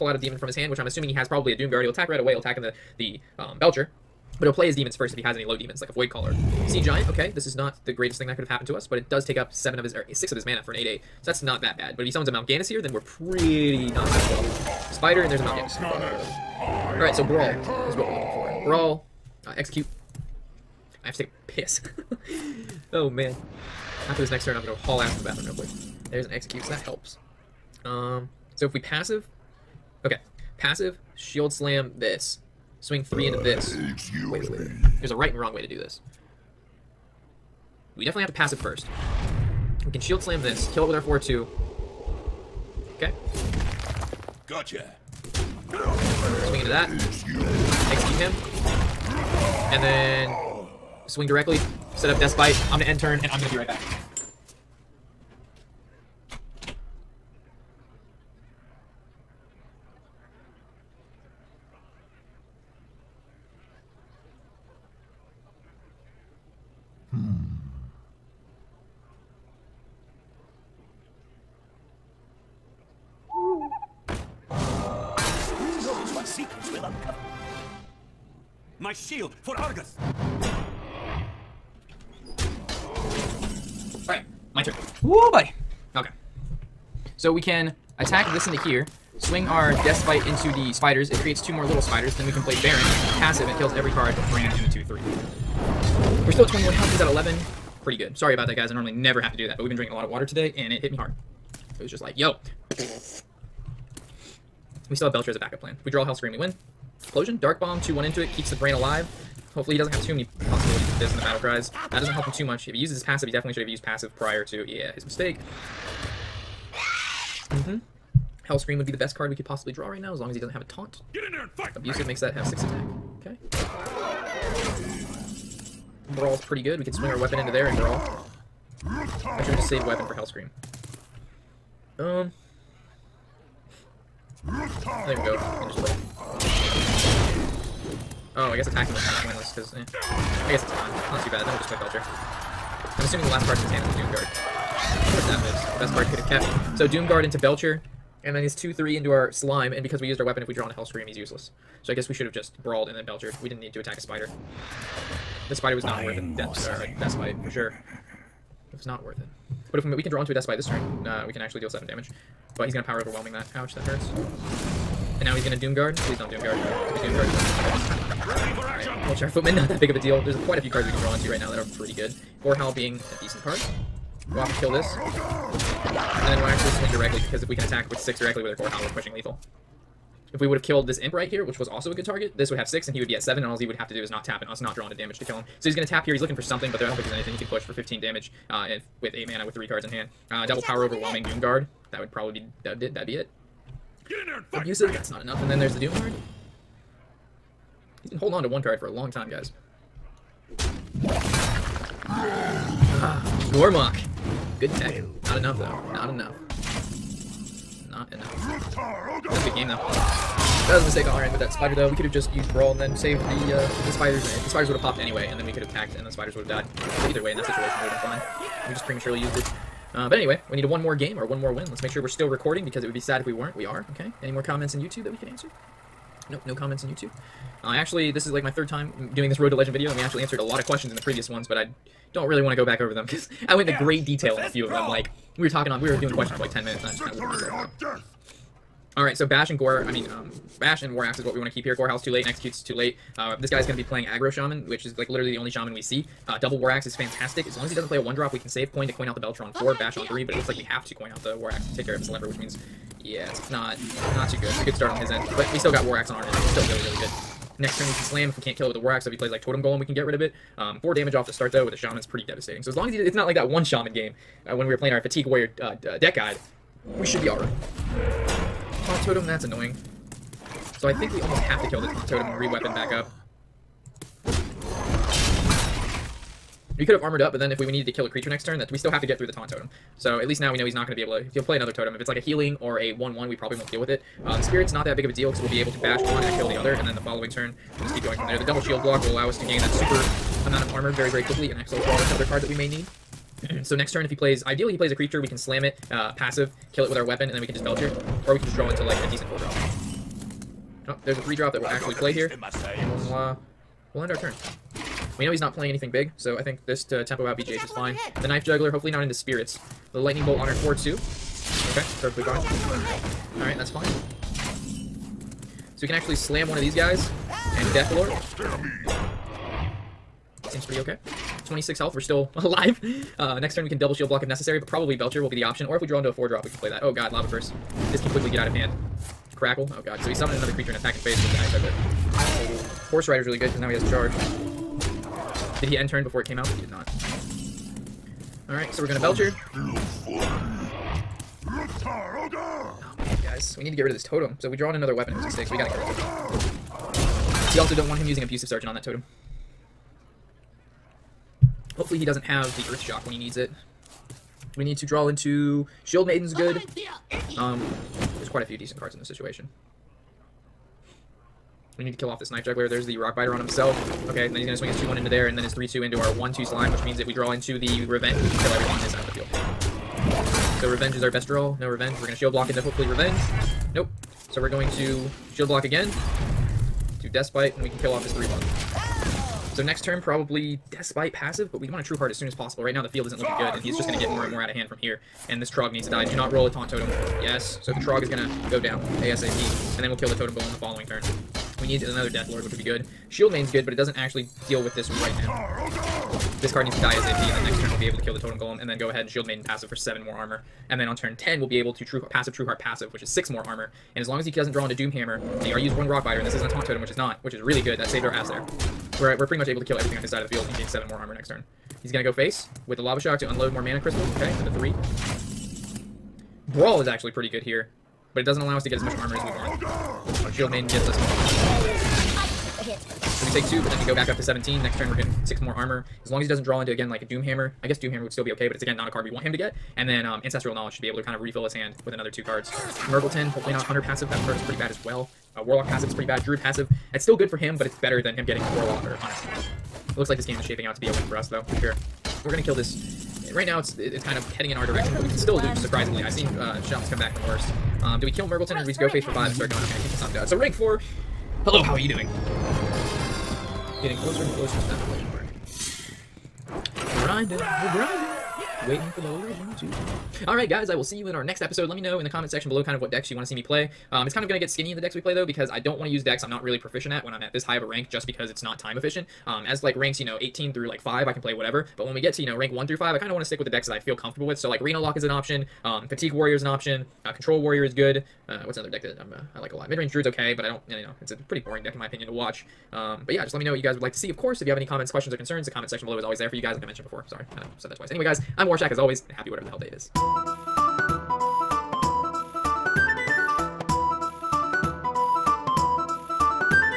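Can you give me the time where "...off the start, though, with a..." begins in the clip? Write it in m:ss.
4:21.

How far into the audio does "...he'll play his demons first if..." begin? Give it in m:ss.
0:04.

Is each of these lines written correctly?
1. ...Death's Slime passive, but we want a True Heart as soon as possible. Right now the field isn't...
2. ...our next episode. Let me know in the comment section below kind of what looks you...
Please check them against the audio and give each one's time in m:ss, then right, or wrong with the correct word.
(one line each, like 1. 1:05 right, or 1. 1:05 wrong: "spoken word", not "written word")
1. 6:20 wrong: "Bite", not "Slime"
2. 7:41 wrong: "decks", not "looks".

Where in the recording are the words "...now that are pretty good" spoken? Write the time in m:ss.
2:51.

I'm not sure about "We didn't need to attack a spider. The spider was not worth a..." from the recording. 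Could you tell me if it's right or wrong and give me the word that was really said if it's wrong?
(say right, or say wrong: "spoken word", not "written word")
right.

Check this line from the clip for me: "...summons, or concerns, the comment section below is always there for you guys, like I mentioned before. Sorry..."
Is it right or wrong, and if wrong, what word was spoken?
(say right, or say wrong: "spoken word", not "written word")
wrong: "questions", not "summons".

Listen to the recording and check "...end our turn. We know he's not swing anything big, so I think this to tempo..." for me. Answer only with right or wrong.
wrong.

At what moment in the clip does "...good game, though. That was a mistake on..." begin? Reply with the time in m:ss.
3:29.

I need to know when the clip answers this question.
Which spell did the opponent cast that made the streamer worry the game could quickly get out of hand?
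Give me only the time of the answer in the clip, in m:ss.
5:27.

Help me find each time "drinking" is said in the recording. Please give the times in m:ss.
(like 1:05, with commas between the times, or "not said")
1:39.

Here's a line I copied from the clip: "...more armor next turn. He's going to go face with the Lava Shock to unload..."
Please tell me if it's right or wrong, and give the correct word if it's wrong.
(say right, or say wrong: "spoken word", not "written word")
right.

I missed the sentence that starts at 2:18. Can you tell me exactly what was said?
Oh, I guess attacking was kind of pointless, because, eh.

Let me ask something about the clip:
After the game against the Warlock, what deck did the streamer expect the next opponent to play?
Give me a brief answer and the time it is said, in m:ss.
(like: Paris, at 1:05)
Aggro Shaman, at 4:04.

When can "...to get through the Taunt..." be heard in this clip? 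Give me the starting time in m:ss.
4:39.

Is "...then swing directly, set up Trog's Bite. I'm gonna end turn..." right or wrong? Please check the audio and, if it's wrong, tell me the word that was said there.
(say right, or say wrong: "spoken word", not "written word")
wrong: "Death", not "Trog".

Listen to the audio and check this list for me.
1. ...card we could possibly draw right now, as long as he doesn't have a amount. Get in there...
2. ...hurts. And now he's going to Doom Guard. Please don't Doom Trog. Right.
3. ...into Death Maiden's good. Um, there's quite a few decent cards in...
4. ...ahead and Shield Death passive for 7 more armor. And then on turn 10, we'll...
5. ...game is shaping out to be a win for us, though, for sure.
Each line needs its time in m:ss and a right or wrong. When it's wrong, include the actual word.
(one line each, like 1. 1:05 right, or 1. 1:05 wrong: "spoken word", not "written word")
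1. 1:59 wrong: "taunt", not "amount"
2. 2:43 wrong: "Guard", not "Trog"
3. 5:55 wrong: "Shield", not "Death"
4. 6:38 wrong: "Maiden", not "Death"
5. 7:20 right.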